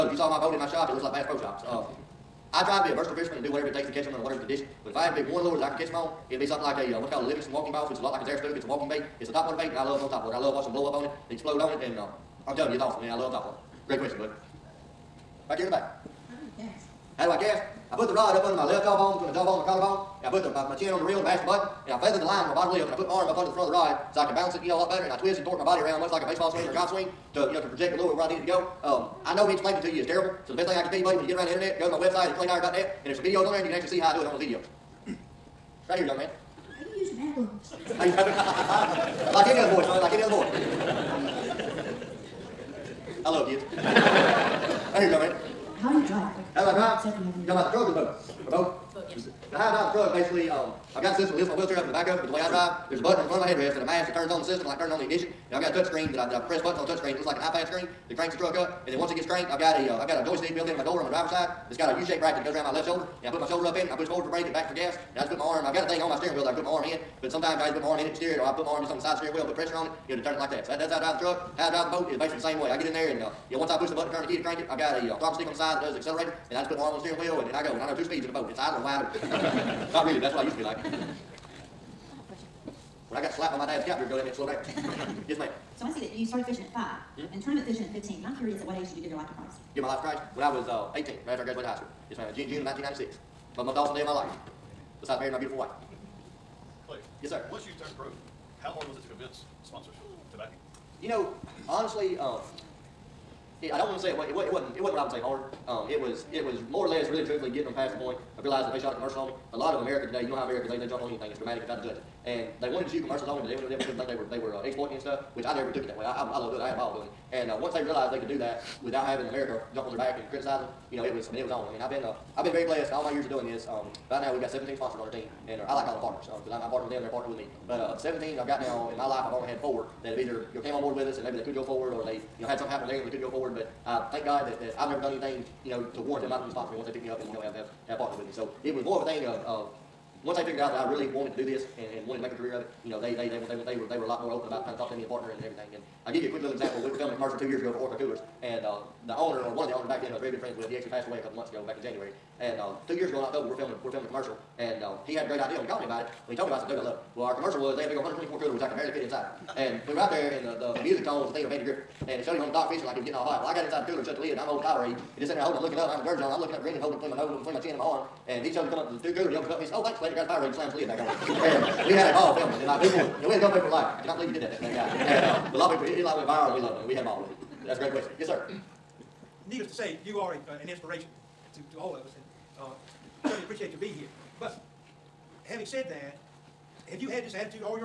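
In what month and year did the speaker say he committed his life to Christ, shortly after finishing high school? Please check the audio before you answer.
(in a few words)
June 1996.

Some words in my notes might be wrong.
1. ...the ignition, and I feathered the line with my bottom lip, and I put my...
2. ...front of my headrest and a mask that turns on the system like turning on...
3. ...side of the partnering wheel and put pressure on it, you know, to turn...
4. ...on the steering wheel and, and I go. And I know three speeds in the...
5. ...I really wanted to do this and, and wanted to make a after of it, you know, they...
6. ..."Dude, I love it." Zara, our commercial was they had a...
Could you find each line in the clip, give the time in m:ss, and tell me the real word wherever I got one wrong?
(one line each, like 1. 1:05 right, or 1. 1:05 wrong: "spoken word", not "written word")
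1. 0:21 wrong: "button", not "ignition"
2. 0:53 right
3. 1:09 wrong: "steering", not "partnering"
4. 1:16 wrong: "two", not "three"
5. 2:20 wrong: "career", not "after"
6. 2:36 wrong: "Well", not "Zara".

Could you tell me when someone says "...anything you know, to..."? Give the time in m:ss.
2:15.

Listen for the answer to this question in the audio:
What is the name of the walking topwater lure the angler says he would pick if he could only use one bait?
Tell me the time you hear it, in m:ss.
0:07.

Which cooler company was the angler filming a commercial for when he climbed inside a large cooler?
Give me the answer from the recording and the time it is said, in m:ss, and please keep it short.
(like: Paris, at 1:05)
Orca, at 2:27.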